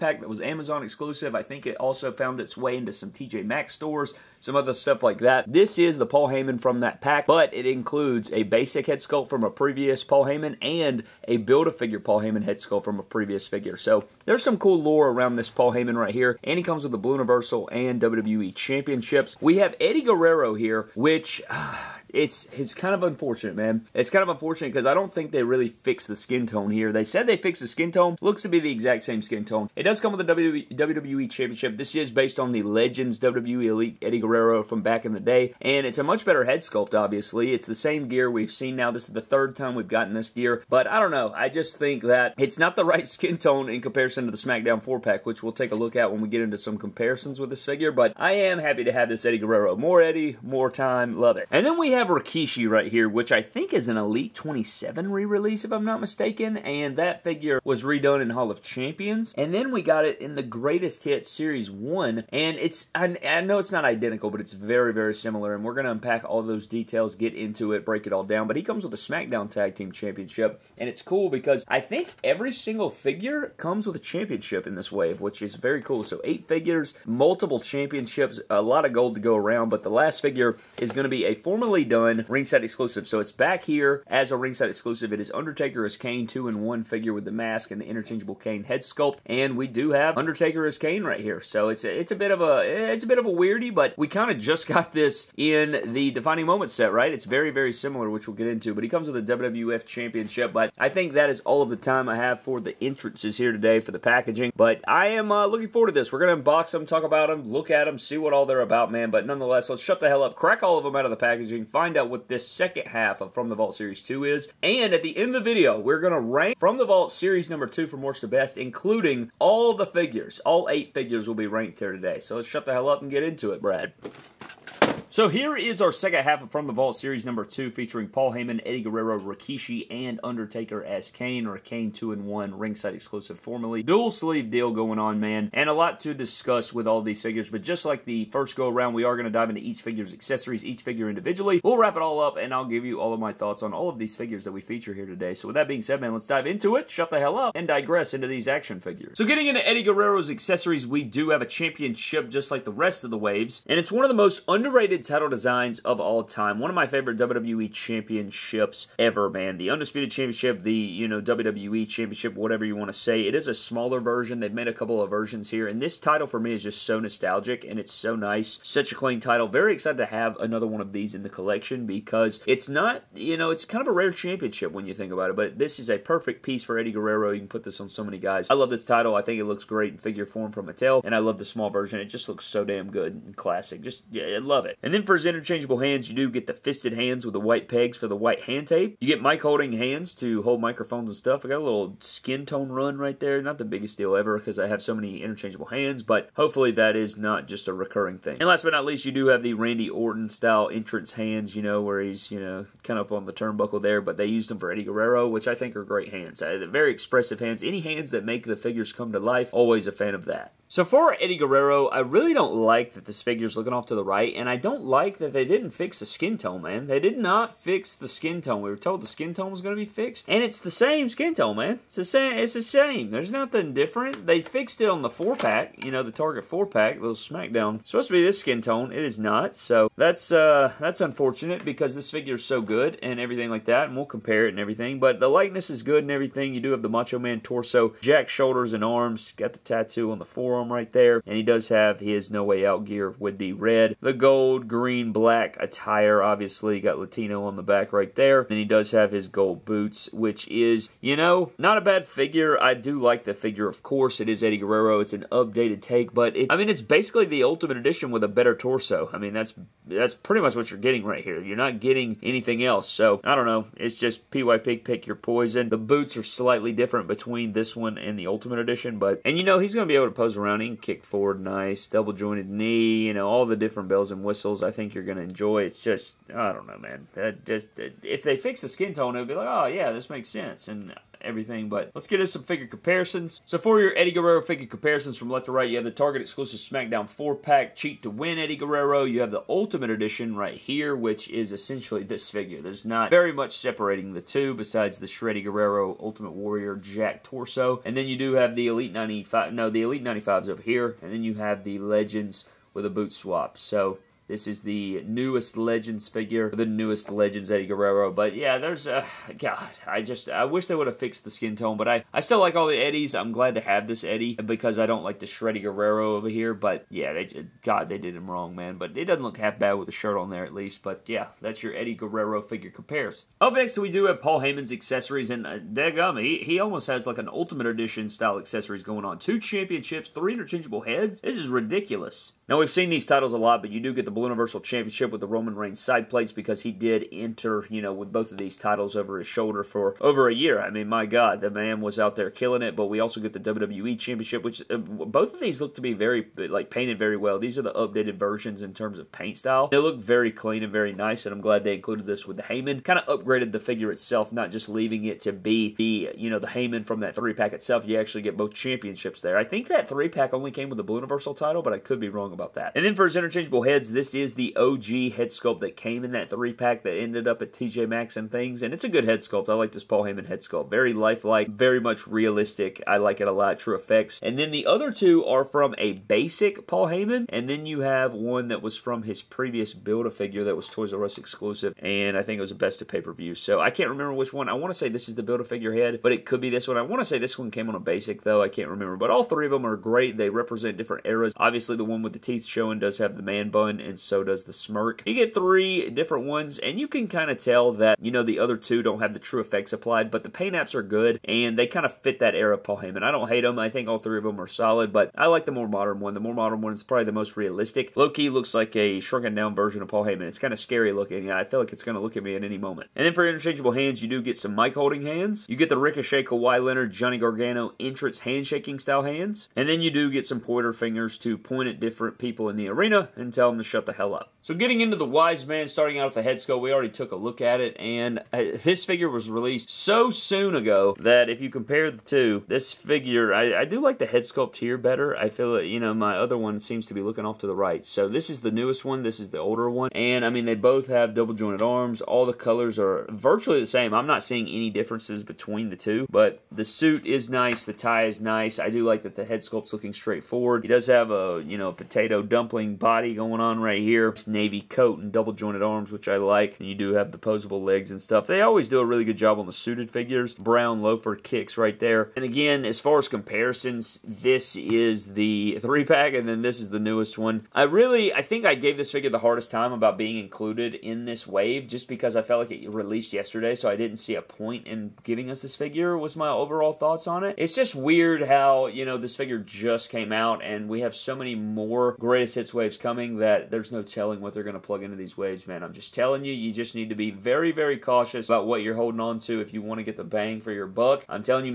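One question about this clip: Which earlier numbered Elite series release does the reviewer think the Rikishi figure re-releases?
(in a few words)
Elite 27.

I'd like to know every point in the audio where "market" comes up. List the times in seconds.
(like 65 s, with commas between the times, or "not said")
not said.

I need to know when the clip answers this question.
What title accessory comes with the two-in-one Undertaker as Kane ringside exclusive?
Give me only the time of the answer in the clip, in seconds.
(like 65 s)
99 s.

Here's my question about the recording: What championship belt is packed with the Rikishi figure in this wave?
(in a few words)
SmackDown Tag Team Championship.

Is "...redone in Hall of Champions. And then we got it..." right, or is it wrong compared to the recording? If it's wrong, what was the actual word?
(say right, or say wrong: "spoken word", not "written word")
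right.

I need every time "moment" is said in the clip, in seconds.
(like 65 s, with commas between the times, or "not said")
96 s, 412 s.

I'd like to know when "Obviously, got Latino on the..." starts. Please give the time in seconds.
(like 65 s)
246 s.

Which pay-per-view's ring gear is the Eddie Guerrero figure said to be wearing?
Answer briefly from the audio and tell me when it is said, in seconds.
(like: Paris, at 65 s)
No Way Out, at 242 s.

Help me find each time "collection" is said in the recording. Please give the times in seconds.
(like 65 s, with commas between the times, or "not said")
171 s.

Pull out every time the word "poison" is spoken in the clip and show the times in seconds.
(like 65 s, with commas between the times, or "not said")
265 s.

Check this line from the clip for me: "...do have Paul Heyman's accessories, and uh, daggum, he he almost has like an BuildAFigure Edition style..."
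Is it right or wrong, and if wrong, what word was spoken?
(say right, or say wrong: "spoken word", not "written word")
wrong: "Ultimate", not "BuildAFigure".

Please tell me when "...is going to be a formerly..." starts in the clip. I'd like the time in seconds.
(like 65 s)
80 s.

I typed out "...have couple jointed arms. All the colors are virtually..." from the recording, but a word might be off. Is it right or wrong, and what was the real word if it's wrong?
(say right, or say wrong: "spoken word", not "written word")
wrong: "double", not "couple".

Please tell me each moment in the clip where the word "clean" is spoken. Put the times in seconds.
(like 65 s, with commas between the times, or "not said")
168 s, 350 s.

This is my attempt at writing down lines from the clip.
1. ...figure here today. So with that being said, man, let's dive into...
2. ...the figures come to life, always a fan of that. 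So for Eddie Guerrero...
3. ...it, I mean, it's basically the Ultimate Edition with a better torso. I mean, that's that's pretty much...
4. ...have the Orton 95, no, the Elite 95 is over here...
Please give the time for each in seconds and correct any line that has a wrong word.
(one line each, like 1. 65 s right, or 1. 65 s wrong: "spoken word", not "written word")
1. 144 s wrong: "feature", not "figure"
2. 208 s right
3. 256 s right
4. 298 s wrong: "Elite", not "Orton".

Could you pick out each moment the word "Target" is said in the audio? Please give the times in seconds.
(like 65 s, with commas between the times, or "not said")
226 s, 285 s.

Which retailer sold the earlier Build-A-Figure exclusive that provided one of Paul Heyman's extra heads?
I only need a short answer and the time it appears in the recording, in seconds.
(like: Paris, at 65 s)
Toys R Us, at 380 s.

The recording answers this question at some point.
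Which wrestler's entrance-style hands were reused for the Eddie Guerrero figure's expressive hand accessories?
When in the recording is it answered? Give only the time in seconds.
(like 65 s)
199 s.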